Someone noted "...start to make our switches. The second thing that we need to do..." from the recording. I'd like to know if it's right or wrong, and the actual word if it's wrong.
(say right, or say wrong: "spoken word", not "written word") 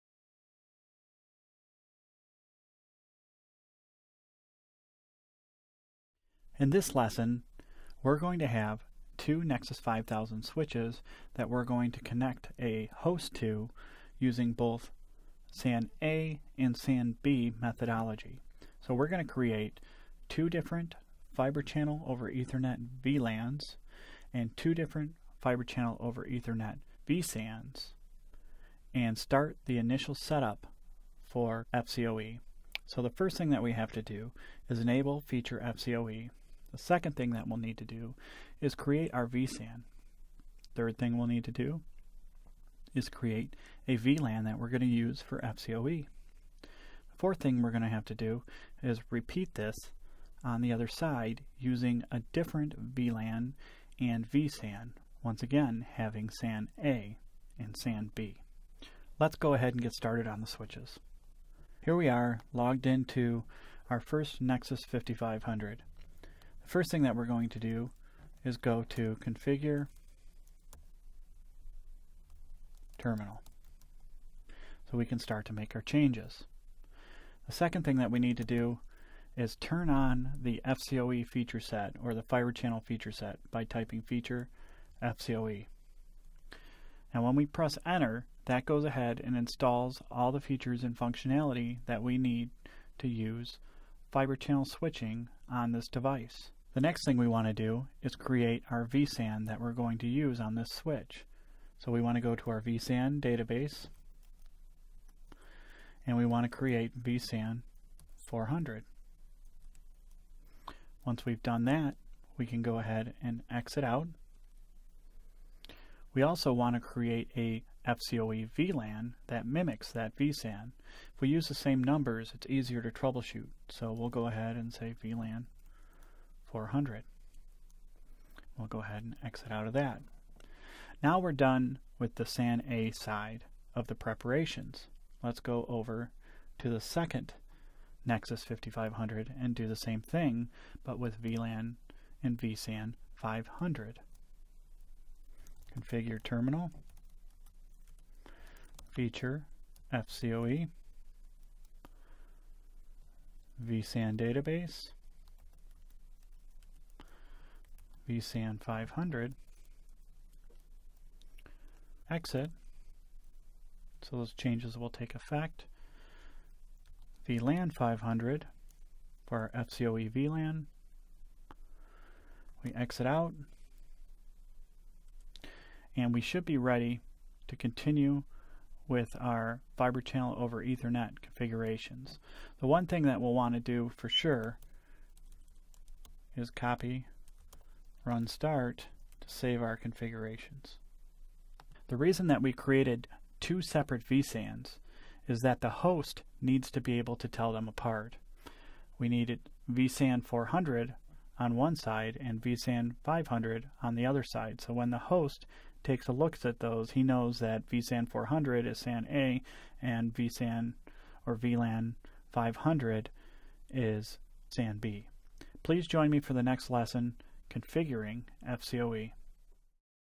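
wrong: "changes", not "switches".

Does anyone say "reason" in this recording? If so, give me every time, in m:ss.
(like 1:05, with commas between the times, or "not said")
3:11.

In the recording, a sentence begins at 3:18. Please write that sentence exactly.
We needed vSAN 400 on one side and vSAN 500 on the other side.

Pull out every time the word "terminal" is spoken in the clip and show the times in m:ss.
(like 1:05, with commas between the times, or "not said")
1:12, 2:26.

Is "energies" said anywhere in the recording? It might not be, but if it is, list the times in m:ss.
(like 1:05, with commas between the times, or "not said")
not said.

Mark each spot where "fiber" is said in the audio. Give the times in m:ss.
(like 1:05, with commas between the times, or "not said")
0:21, 0:25, 1:22, 1:34, 2:59.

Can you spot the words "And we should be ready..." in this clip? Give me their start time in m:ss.
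2:55.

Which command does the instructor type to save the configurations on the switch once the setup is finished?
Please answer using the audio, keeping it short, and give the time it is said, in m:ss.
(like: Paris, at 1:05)
copy run start, at 3:06.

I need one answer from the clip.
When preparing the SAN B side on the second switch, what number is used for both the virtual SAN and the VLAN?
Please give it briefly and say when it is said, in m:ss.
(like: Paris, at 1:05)
500, at 2:21.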